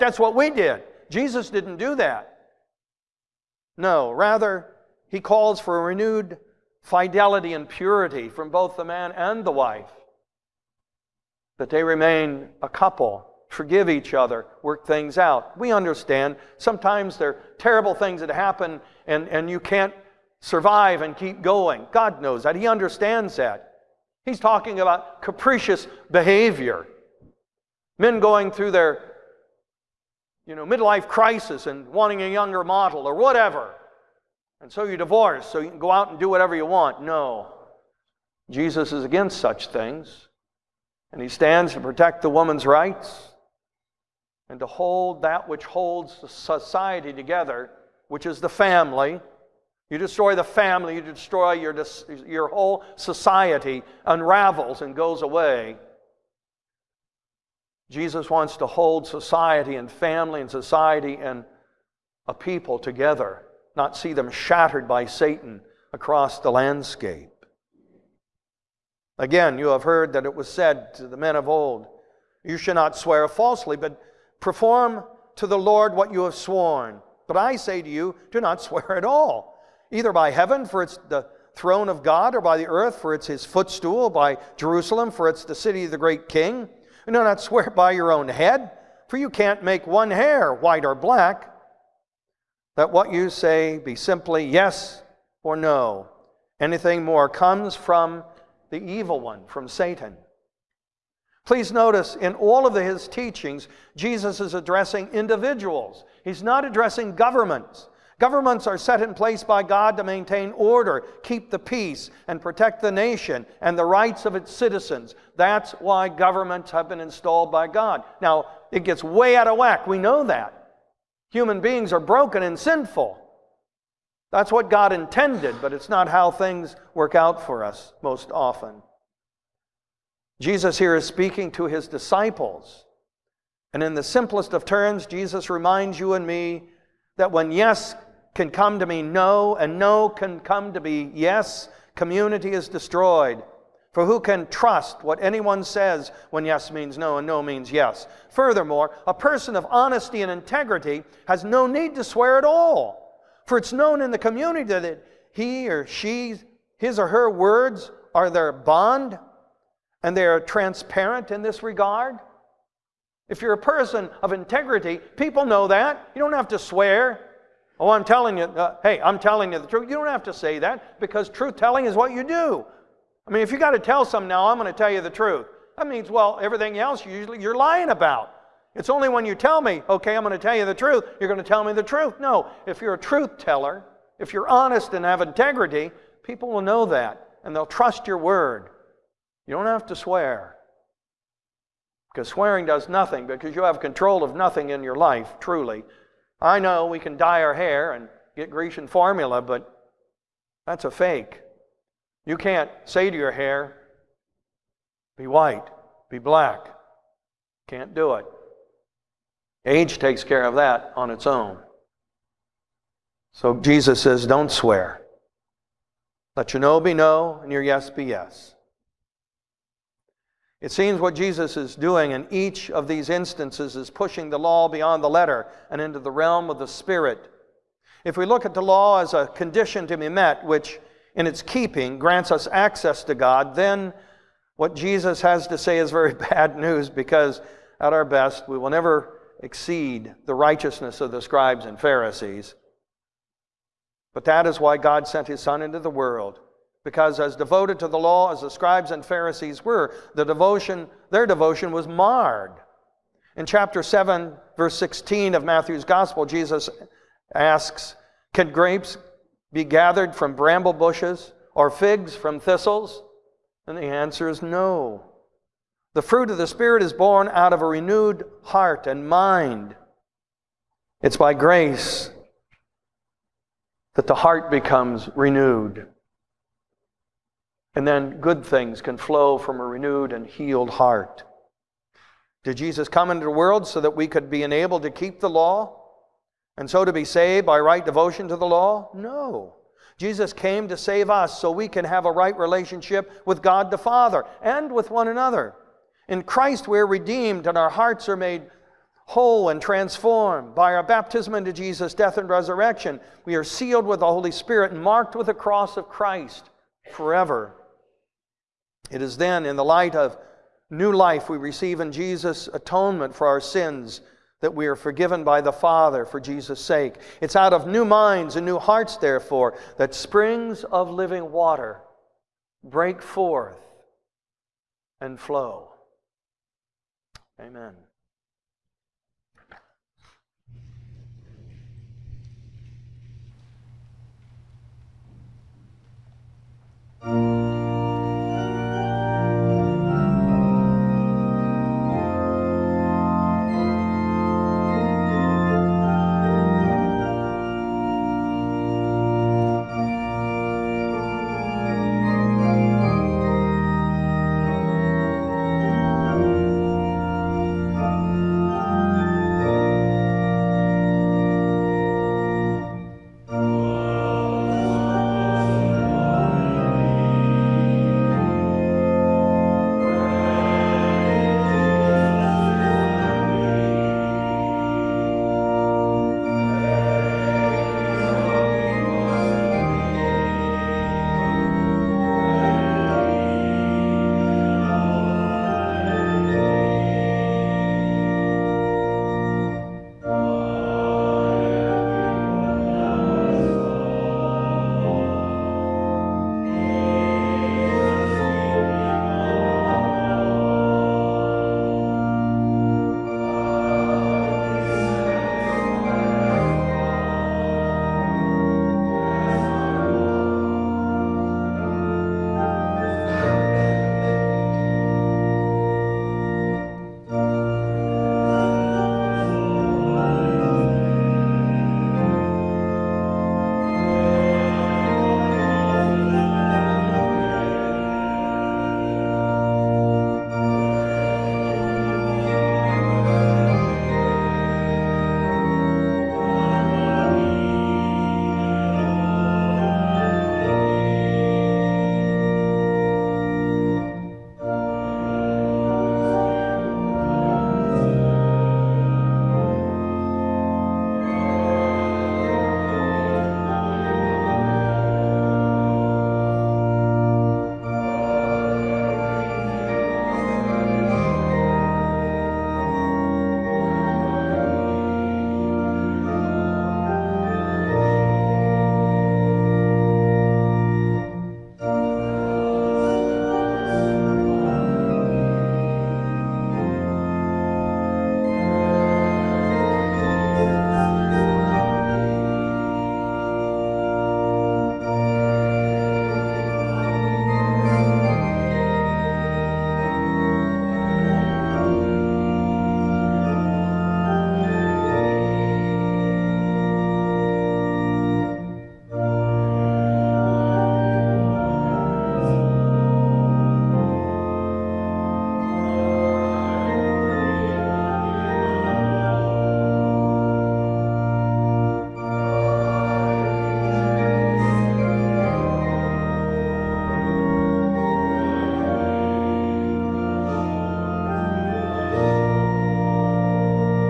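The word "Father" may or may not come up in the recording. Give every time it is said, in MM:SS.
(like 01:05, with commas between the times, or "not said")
04:53, 05:15.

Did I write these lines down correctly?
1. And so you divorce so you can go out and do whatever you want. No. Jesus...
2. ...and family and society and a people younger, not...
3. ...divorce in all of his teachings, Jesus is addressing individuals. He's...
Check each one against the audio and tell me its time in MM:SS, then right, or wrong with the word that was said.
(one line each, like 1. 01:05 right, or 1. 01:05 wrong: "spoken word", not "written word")
1. 00:34 right
2. 00:59 wrong: "together", not "younger"
3. 01:41 wrong: "notice", not "divorce".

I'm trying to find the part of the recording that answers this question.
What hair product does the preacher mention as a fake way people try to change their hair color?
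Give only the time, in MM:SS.
03:18.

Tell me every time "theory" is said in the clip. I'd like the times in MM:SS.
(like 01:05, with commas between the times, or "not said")
not said.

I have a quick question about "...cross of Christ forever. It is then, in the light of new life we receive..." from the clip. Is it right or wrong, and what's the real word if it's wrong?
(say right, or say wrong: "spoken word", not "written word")
right.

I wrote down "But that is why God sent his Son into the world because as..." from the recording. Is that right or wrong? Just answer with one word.
right.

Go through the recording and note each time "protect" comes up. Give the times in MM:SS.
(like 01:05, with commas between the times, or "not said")
00:41, 01:52.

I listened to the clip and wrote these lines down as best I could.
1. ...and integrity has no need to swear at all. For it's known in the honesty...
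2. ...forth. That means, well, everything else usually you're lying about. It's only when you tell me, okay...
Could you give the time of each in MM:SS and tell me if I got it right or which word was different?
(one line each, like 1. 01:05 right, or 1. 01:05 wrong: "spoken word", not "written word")
1. 02:30 wrong: "community", not "honesty"
2. 02:55 wrong: "truth", not "forth".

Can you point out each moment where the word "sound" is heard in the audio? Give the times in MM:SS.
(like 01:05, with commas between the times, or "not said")
not said.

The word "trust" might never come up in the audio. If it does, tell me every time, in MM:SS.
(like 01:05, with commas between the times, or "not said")
02:24, 03:07.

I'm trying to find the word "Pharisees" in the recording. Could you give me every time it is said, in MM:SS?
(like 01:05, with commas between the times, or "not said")
04:01, 04:09.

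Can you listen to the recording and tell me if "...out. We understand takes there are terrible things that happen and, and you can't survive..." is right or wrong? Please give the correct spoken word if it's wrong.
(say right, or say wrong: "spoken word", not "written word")
wrong: "sometimes", not "takes".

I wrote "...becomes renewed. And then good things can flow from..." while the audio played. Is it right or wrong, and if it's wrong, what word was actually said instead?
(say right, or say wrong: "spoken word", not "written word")
right.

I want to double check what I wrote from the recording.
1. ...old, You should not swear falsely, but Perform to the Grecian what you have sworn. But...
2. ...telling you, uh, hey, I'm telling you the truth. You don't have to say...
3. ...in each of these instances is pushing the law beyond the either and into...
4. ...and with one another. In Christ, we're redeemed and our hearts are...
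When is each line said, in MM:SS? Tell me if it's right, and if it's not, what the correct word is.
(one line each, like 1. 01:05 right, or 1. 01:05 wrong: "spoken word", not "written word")
1. 01:11 wrong: "Lord", not "Grecian"
2. 02:48 right
3. 03:42 wrong: "letter", not "either"
4. 04:54 right.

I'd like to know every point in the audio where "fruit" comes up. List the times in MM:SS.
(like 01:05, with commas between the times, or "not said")
04:26.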